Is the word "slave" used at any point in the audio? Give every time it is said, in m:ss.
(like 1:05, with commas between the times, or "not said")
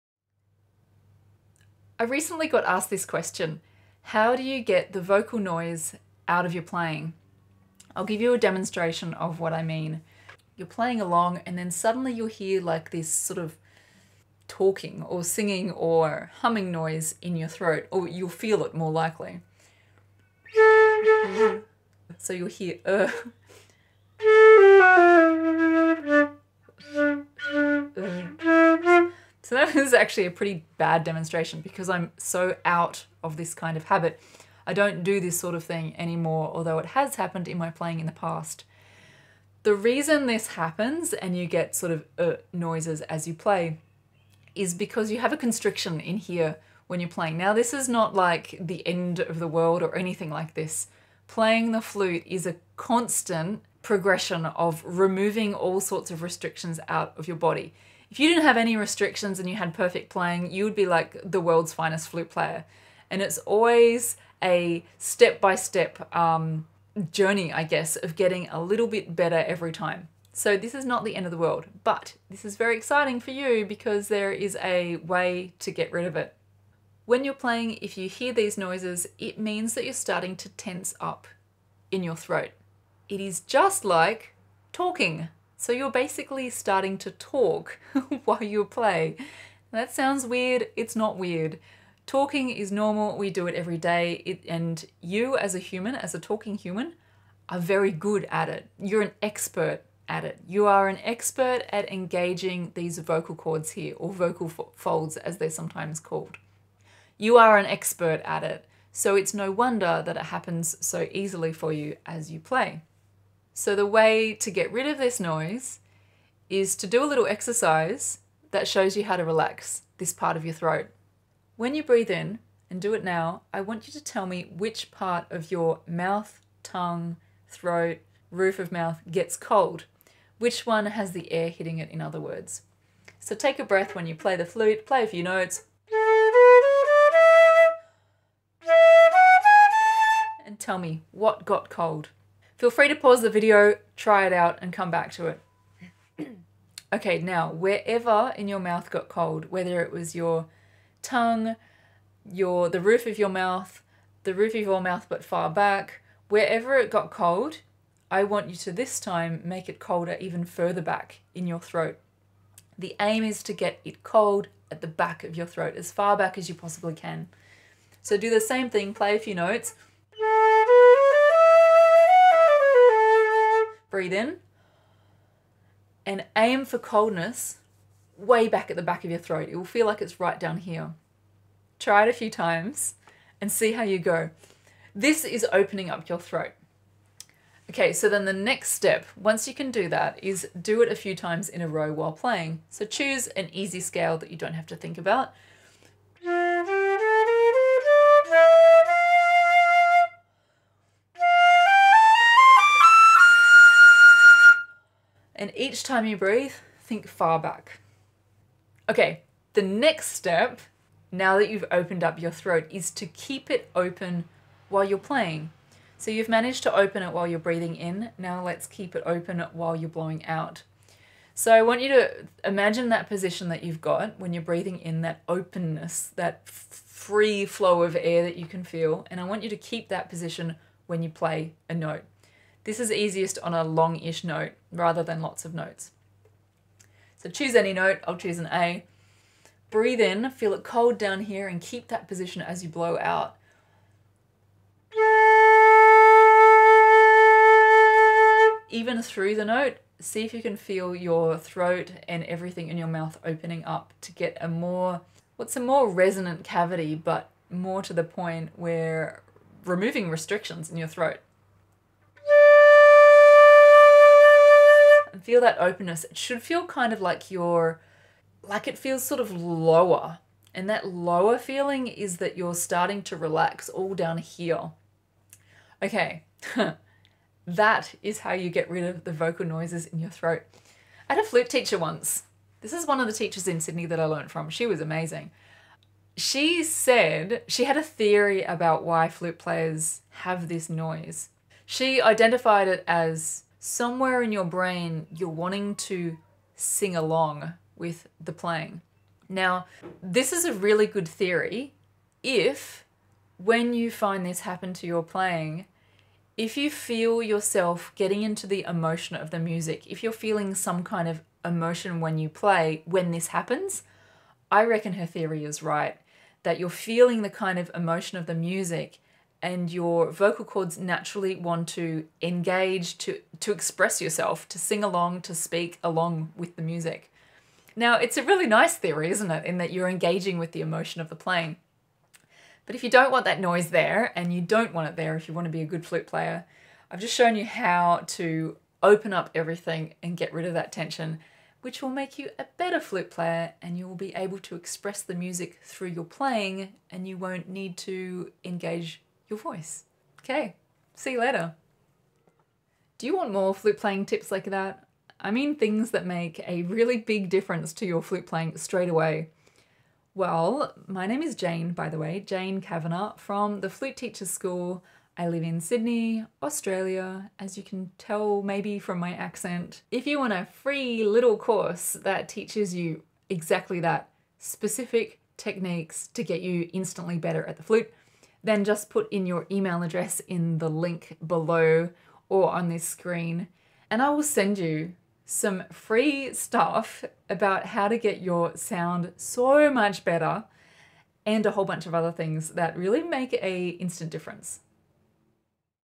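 not said.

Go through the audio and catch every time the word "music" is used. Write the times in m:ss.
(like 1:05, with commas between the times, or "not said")
5:09, 5:18, 5:26, 5:45.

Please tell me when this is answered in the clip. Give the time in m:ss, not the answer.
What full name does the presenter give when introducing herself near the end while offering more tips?
6:02.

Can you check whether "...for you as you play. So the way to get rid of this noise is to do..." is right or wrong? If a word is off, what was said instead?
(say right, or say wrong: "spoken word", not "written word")
right.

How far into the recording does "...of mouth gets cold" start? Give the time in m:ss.
2:08.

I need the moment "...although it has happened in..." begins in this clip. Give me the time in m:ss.
0:36.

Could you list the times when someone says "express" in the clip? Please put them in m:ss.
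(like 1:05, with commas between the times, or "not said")
5:23, 5:44.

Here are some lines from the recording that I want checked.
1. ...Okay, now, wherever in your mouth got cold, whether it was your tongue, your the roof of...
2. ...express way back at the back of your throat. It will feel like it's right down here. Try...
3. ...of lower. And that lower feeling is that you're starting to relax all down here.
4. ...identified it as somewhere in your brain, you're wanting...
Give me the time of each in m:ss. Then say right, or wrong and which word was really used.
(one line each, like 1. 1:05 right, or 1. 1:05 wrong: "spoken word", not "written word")
1. 2:26 right
2. 2:56 wrong: "coldness", not "express"
3. 4:29 right
4. 4:52 right.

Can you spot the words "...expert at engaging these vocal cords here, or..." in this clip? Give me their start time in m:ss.
1:41.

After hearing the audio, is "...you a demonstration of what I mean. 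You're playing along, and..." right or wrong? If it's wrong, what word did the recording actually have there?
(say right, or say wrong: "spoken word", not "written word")
right.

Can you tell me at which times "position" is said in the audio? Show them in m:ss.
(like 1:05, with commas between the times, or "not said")
3:43, 3:50, 4:02.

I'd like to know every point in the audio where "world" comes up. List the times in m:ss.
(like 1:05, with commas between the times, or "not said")
0:49, 1:01, 1:11.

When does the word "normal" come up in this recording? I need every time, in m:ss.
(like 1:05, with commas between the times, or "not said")
1:32.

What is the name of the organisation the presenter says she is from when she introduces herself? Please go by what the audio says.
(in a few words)
Flute Teachers School.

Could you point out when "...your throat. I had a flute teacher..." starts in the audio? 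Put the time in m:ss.
4:39.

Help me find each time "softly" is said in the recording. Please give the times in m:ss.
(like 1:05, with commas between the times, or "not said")
not said.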